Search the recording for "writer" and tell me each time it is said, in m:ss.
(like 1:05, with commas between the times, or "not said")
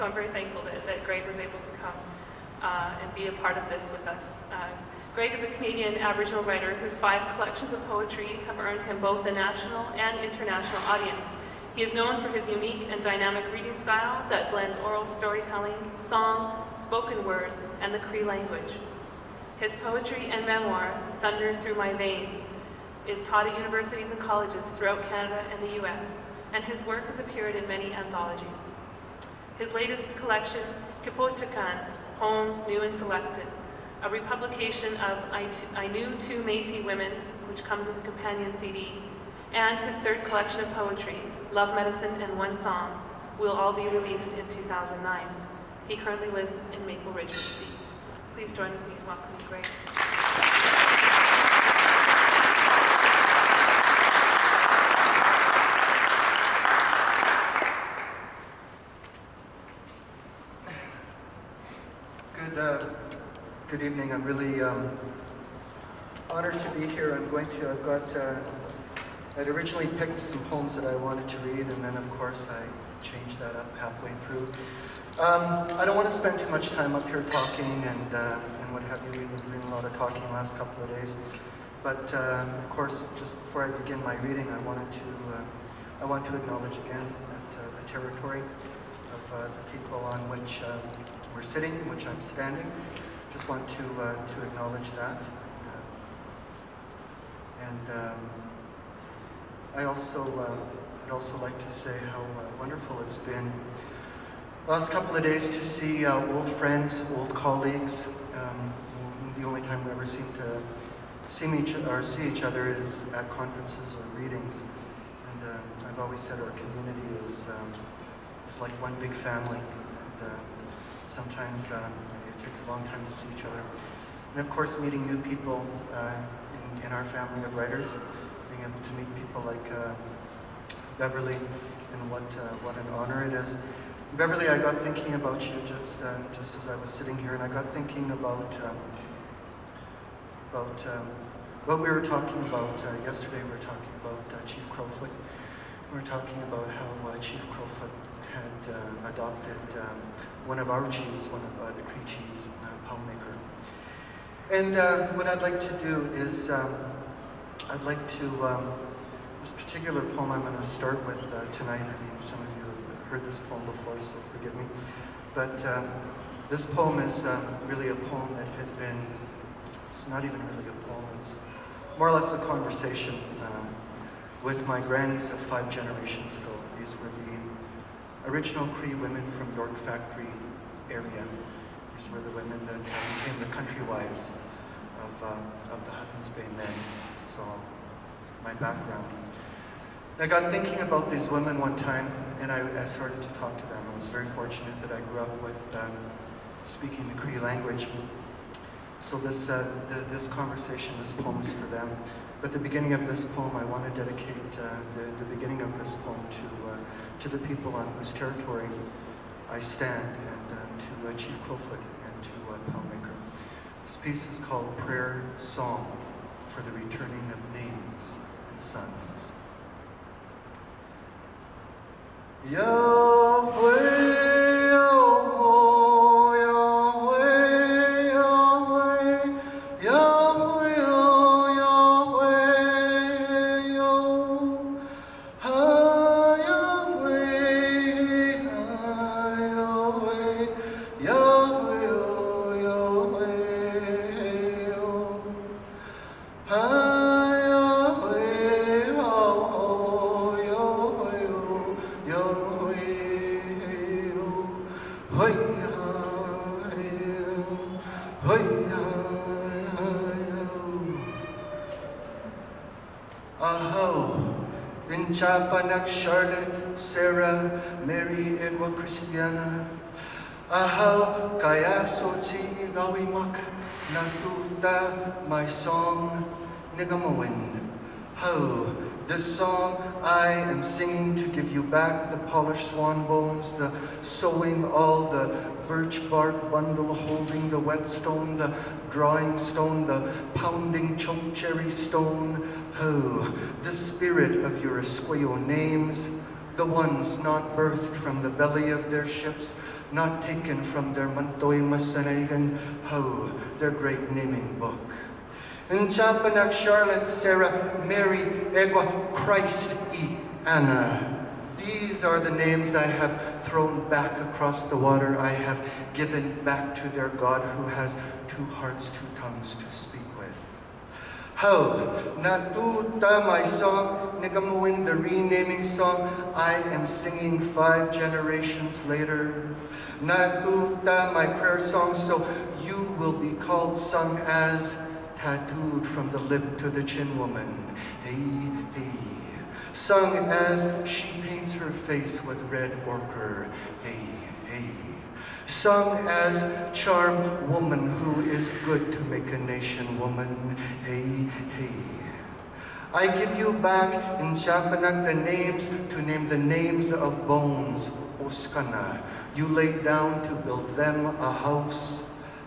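0:06, 2:07.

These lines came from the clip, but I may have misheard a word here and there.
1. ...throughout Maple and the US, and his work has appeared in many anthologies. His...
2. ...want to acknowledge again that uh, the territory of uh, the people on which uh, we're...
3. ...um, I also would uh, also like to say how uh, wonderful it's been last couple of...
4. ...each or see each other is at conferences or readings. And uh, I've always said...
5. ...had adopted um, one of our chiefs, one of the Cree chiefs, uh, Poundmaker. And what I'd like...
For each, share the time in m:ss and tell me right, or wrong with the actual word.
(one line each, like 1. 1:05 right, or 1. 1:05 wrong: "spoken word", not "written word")
1. 0:24 wrong: "Canada", not "Maple"
2. 1:26 right
3. 1:37 right
4. 1:51 right
5. 2:28 right.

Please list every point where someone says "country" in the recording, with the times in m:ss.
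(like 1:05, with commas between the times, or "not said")
3:03.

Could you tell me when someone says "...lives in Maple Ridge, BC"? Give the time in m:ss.
0:46.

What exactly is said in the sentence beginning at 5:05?
Nchapanak Charlotte Sarah Mary Egwa Christ E.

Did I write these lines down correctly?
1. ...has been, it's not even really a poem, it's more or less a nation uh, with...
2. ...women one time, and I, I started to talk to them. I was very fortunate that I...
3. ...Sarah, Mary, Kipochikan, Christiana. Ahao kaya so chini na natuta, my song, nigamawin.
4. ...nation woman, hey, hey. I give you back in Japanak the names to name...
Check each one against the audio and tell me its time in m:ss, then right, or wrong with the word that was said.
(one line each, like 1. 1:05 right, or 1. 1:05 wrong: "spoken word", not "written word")
1. 2:48 wrong: "conversation", not "nation"
2. 3:11 right
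3. 4:26 wrong: "Edwa", not "Kipochikan"
4. 5:49 right.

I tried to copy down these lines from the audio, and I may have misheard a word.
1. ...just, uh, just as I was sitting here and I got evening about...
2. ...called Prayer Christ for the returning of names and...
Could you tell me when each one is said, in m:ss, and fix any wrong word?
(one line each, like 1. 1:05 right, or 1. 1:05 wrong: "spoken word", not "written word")
1. 2:15 wrong: "thinking", not "evening"
2. 3:34 wrong: "Song", not "Christ".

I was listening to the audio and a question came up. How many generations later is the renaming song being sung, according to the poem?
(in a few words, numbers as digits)
5.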